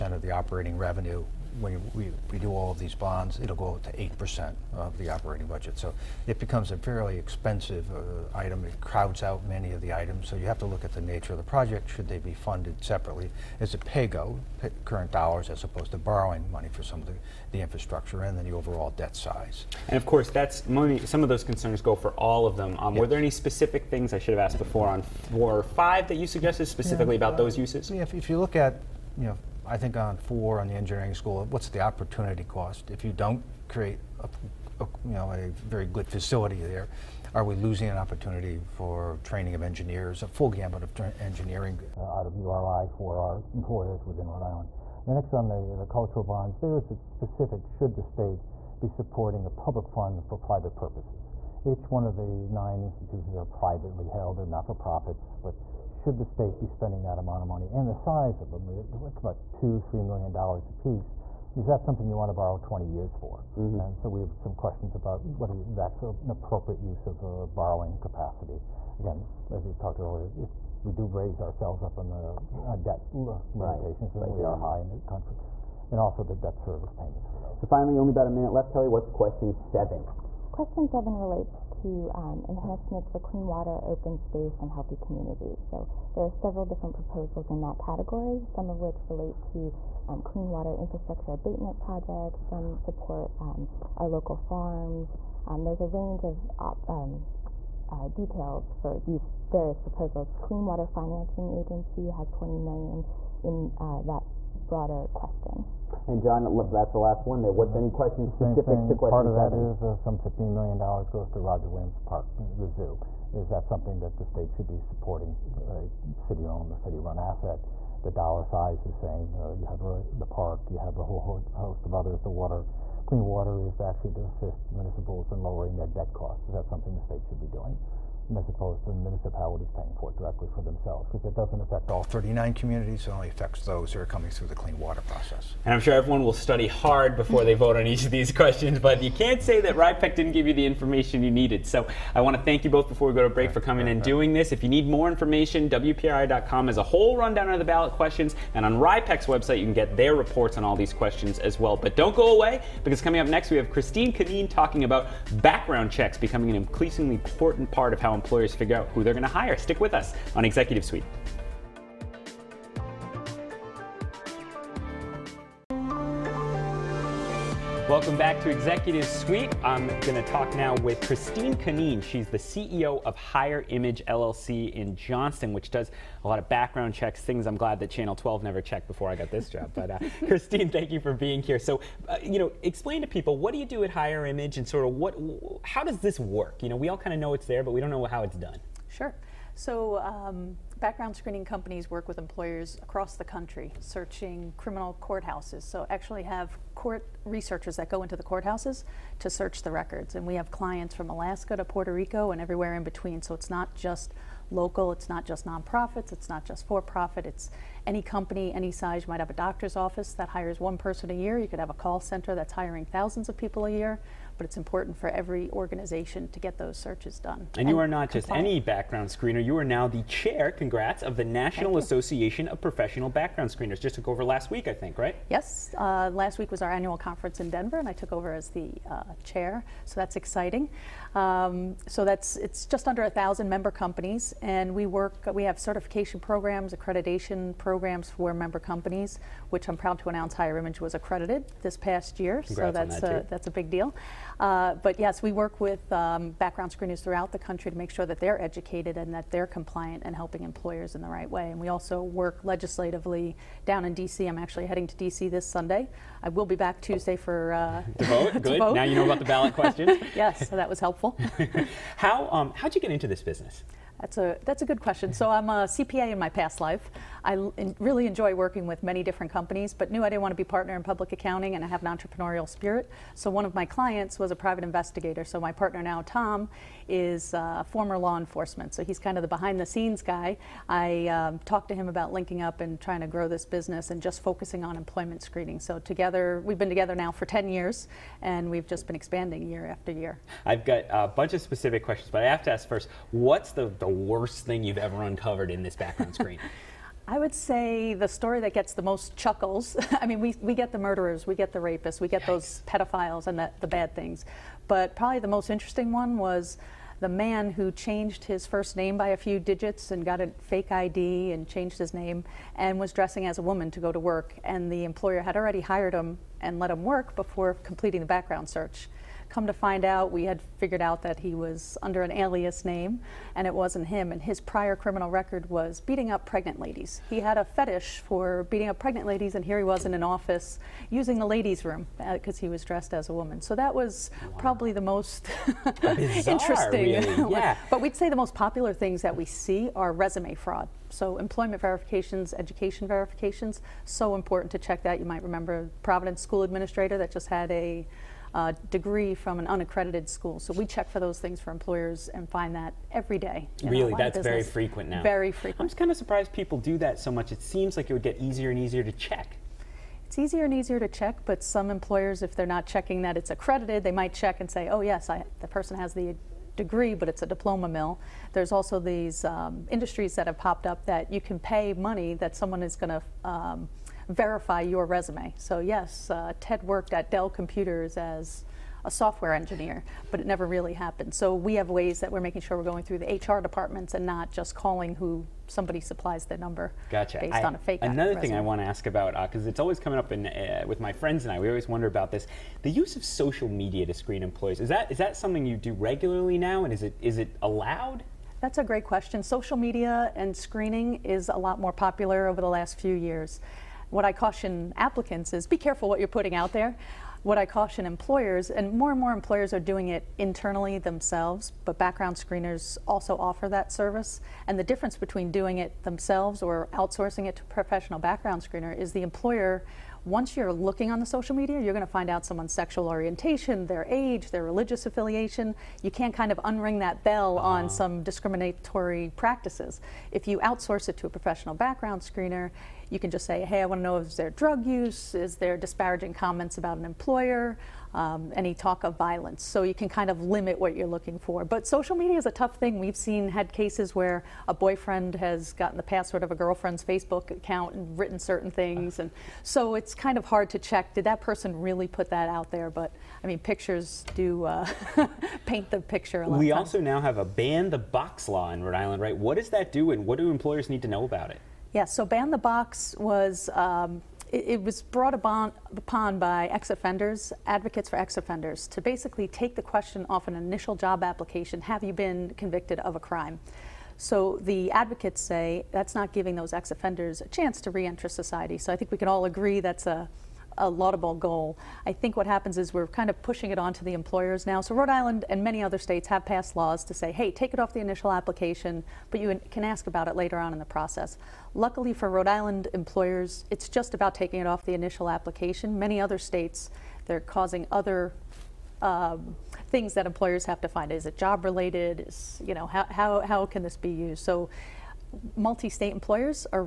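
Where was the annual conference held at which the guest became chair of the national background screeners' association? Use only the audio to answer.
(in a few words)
Denver.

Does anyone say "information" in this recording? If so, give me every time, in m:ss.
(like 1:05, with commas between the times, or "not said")
2:20, 2:25.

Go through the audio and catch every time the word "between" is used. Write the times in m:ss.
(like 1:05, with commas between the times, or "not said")
3:22, 6:54.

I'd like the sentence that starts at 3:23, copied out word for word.
So it's not just local, it's not just nonprofits, it's not just for profit, it's any company, any size.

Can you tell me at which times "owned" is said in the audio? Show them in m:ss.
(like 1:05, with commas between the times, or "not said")
1:56.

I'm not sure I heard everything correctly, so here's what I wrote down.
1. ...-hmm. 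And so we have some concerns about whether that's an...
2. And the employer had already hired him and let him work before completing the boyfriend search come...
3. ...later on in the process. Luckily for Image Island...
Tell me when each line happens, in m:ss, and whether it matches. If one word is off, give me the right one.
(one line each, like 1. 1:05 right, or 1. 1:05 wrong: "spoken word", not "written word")
1. 1:03 wrong: "questions", not "concerns"
2. 5:14 wrong: "background", not "boyfriend"
3. 8:10 wrong: "Rhode", not "Image".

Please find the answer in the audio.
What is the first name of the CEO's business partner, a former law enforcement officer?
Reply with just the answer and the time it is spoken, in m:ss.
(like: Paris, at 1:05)
Tom, at 4:36.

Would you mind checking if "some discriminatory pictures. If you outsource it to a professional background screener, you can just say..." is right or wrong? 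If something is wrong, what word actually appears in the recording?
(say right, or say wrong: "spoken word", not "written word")
wrong: "practices", not "pictures".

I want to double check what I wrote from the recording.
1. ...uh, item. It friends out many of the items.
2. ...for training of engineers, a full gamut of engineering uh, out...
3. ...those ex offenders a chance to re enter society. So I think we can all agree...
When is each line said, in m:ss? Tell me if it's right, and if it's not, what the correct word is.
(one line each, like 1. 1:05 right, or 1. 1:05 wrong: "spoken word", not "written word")
1. 0:07 wrong: "crowds", not "friends"
2. 0:38 right
3. 7:56 right.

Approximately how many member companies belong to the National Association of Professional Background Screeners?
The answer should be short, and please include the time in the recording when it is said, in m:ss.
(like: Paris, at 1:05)
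just under a thousand, at 3:52.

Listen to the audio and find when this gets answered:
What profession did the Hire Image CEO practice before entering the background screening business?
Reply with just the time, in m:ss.
4:25.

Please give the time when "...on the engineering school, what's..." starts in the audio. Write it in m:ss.
0:30.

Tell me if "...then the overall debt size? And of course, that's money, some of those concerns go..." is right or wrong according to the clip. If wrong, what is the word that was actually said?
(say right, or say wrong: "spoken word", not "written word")
right.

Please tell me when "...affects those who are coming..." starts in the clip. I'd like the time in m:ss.
2:13.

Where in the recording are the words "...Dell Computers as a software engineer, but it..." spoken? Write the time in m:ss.
6:17.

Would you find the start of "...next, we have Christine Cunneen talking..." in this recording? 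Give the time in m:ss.
2:33.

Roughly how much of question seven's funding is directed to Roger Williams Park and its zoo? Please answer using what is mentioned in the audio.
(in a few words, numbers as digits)
$15 million.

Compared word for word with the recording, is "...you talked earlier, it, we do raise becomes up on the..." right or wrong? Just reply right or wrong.
wrong.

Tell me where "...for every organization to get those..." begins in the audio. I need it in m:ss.
3:34.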